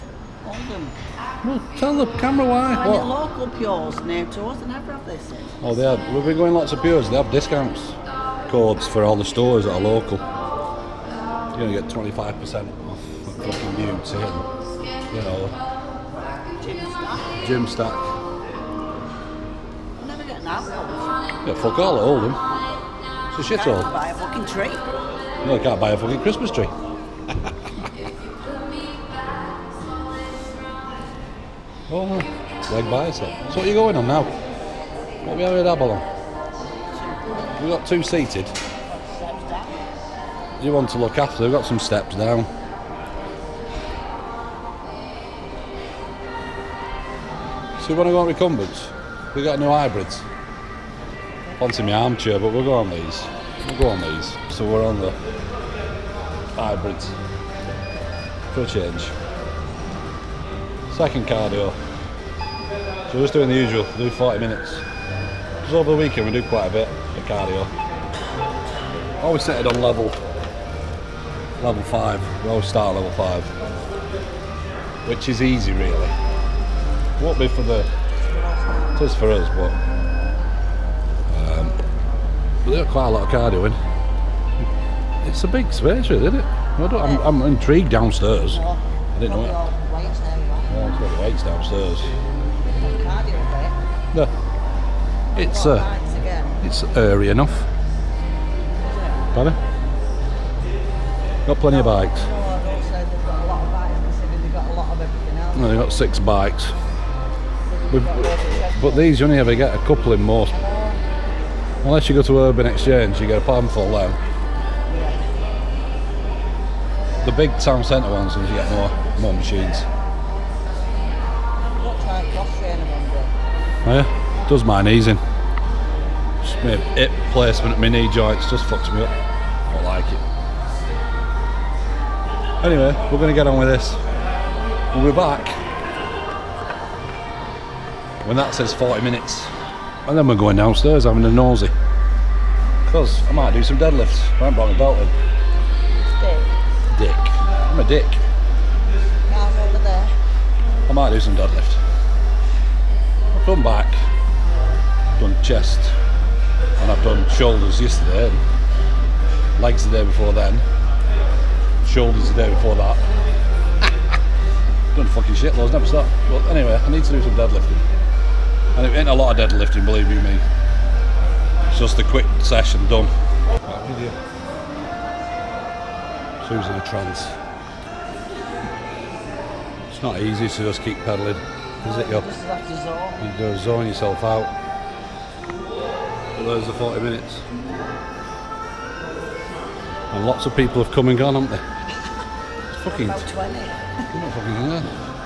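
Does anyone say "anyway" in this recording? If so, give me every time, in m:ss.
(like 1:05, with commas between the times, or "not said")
2:12, 2:46.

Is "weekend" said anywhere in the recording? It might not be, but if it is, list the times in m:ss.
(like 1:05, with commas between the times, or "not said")
1:05.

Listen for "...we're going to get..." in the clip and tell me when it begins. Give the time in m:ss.
2:13.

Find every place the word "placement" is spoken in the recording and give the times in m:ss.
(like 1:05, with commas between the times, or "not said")
2:07.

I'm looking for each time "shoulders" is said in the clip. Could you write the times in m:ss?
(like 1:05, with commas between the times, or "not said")
2:37, 2:41.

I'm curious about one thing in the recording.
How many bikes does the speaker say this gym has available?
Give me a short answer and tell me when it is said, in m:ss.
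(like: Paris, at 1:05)
6, at 1:45.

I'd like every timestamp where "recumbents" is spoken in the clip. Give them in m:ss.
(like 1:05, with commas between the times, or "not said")
0:48.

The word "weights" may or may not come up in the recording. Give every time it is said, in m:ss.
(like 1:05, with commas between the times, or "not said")
1:31.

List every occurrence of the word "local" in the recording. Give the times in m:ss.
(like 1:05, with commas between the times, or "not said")
0:03, 0:09.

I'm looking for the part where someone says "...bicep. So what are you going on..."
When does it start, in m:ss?
0:32.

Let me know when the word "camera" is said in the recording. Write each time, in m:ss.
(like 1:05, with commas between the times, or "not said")
0:02.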